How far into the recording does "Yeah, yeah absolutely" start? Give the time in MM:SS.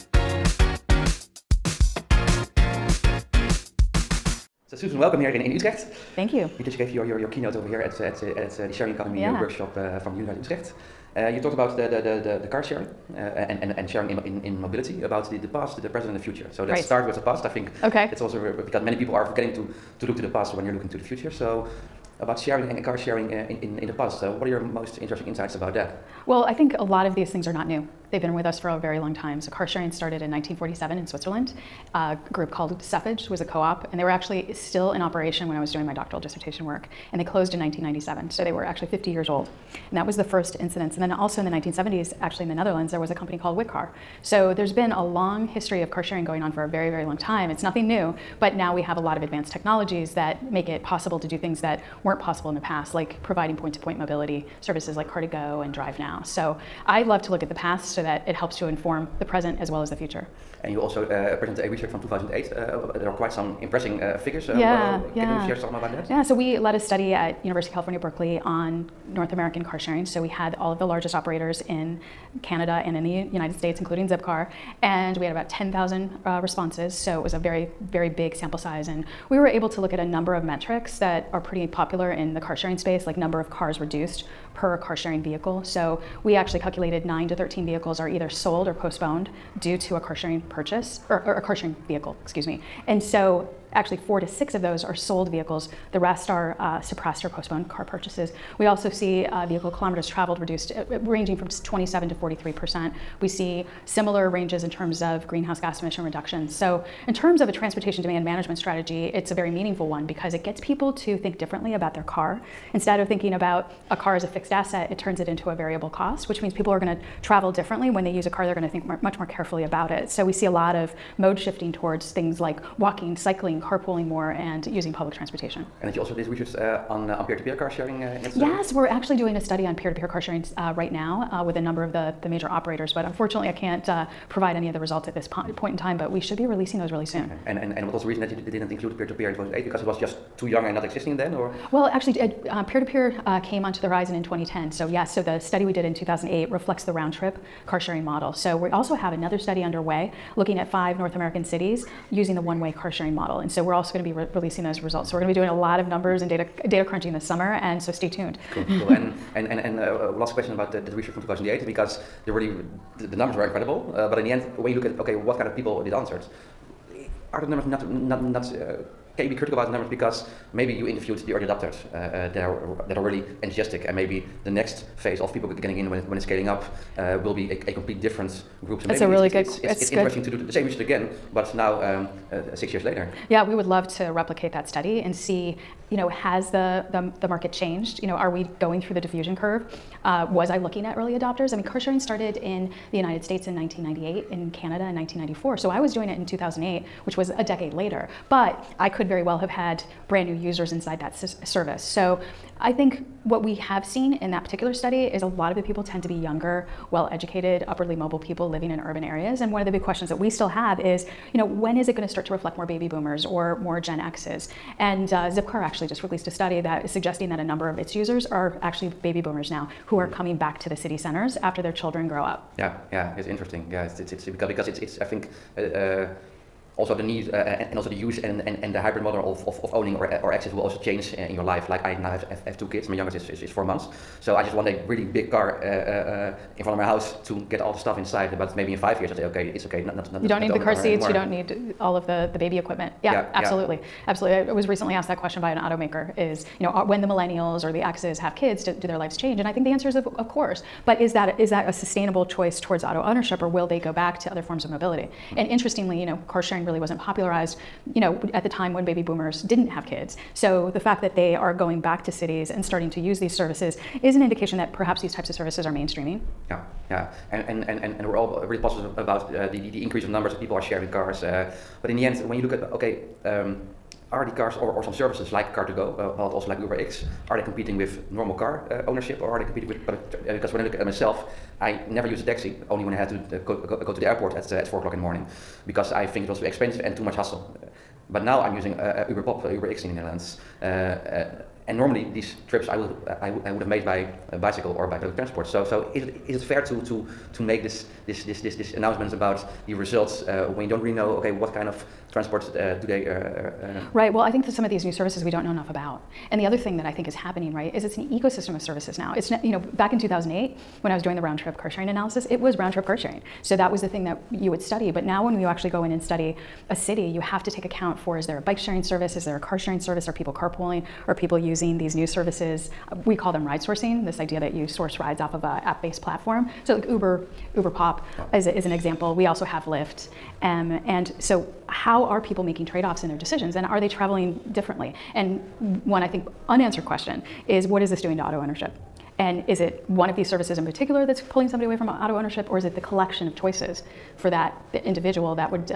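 04:03.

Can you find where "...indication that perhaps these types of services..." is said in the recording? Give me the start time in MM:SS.
04:24.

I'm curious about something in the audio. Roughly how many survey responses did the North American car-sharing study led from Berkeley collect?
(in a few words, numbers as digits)
10,000.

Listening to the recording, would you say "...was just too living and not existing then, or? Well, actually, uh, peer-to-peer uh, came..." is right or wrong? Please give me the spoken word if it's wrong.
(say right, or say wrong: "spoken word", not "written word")
wrong: "young", not "living".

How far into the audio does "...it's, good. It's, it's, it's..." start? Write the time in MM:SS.
02:59.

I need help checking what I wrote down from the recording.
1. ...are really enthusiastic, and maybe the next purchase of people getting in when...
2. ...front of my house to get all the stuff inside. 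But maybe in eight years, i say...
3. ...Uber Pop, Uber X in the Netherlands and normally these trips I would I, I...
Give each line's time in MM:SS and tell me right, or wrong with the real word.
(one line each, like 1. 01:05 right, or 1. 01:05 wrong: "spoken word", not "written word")
1. 02:52 wrong: "phase", not "purchase"
2. 03:56 wrong: "five", not "eight"
3. 04:48 right.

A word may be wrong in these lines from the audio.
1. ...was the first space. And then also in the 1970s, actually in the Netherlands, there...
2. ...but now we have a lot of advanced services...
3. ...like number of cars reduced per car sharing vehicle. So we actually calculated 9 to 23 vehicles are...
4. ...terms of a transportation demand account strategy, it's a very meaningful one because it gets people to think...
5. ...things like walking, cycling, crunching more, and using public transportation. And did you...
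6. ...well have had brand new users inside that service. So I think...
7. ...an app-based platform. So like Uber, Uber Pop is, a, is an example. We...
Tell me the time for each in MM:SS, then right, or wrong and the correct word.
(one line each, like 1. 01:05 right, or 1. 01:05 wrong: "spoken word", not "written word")
1. 00:40 wrong: "incidence", not "space"
2. 00:48 wrong: "technologies", not "services"
3. 01:23 wrong: "13", not "23"
4. 01:47 wrong: "management", not "account"
5. 02:02 wrong: "carpooling", not "crunching"
6. 03:19 right
7. 05:25 right.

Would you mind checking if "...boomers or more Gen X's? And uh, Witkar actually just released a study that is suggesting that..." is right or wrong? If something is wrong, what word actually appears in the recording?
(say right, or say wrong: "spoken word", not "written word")
wrong: "Zipcar", not "Witkar".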